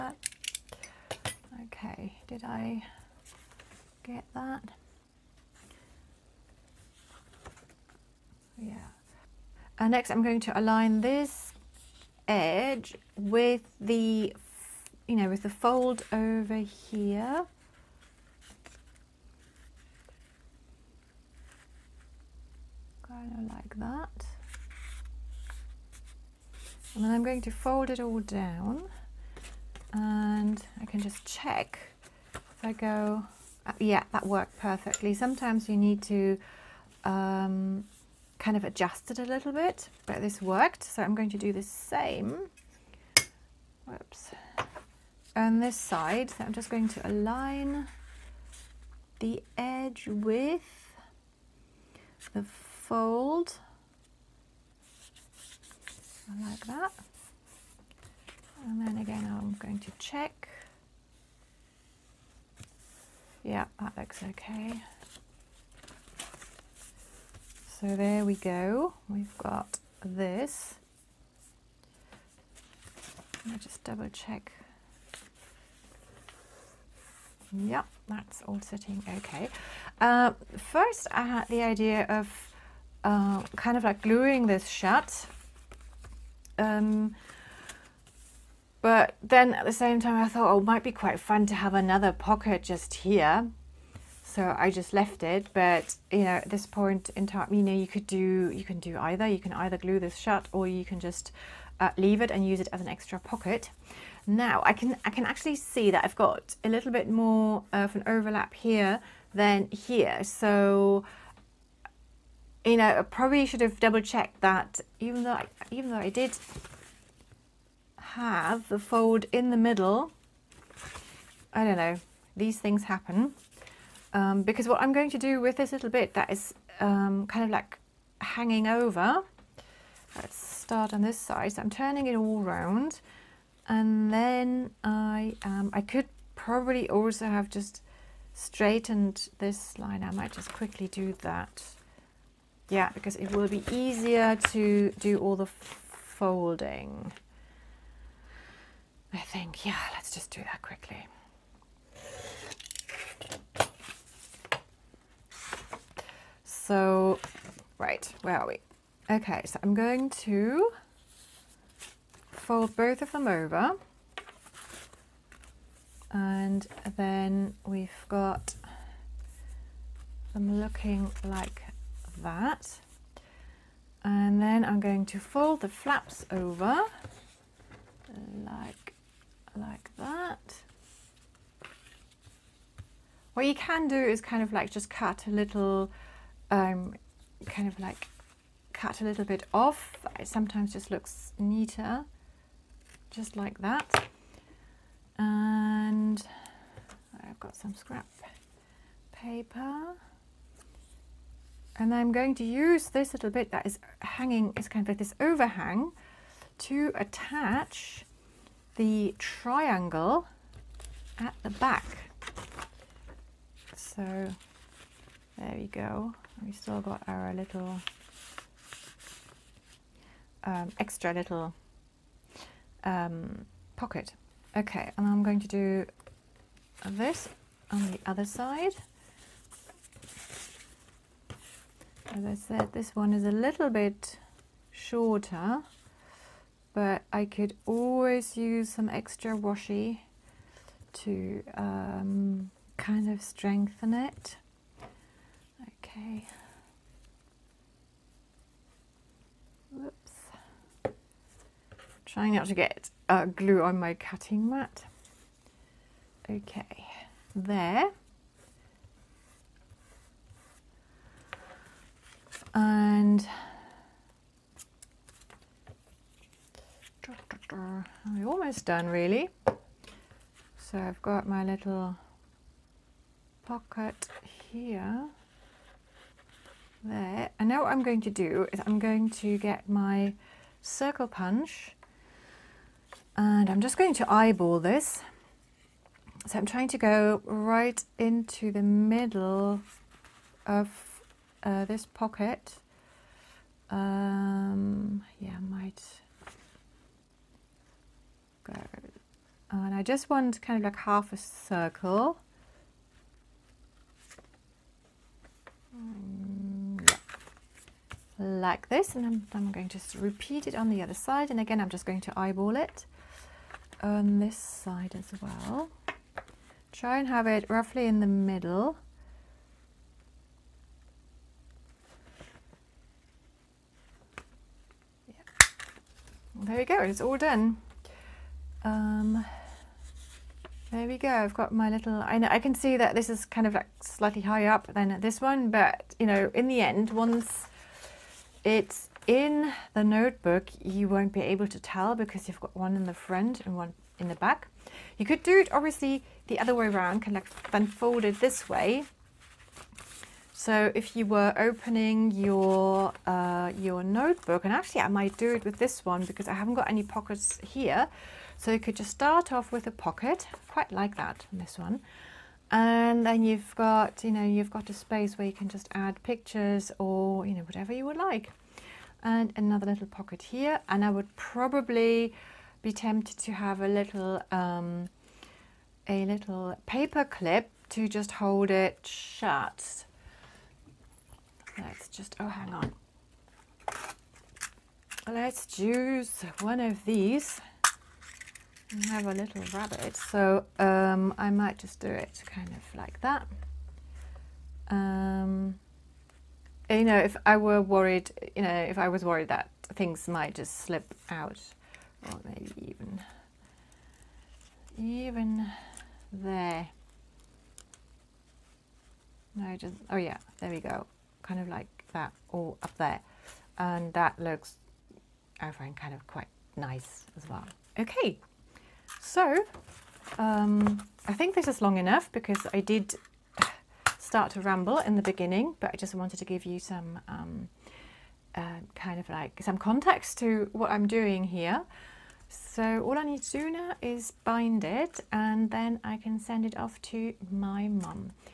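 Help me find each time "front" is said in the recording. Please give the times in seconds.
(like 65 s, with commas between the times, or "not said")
342 s.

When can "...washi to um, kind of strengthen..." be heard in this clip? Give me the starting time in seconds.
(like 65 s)
239 s.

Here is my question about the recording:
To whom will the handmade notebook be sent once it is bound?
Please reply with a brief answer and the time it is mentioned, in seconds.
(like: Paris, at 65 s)
mum, at 437 s.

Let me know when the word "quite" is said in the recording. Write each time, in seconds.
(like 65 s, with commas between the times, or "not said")
90 s, 360 s, 416 s.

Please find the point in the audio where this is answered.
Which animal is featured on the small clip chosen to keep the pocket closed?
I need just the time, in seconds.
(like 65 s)
389 s.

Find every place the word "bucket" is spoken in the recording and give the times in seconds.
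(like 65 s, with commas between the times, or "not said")
not said.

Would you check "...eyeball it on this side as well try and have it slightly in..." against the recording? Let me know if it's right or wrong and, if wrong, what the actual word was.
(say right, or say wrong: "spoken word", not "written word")
wrong: "roughly", not "slightly".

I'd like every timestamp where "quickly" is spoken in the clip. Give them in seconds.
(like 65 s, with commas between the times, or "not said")
140 s, 150 s.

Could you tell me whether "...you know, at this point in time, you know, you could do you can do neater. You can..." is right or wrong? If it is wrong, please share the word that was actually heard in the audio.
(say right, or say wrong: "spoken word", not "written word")
wrong: "either", not "neater".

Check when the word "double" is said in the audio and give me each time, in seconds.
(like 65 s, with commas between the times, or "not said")
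73 s, 113 s.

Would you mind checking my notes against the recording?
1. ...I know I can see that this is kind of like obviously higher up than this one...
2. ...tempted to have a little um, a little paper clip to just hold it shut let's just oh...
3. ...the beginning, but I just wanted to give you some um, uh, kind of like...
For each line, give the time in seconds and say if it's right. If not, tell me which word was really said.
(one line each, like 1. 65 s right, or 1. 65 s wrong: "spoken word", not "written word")
1. 332 s wrong: "slightly", not "obviously"
2. 372 s right
3. 424 s right.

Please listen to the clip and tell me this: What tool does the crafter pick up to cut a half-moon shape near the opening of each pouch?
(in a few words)
circle punch.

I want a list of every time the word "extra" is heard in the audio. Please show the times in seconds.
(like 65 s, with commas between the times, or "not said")
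102 s, 220 s, 238 s.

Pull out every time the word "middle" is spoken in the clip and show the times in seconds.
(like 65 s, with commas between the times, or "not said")
119 s, 288 s, 318 s.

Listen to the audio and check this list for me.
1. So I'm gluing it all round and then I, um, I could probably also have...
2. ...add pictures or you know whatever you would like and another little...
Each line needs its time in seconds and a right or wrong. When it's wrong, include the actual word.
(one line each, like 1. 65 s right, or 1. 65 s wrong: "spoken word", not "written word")
1. 131 s wrong: "turning", not "gluing"
2. 365 s right.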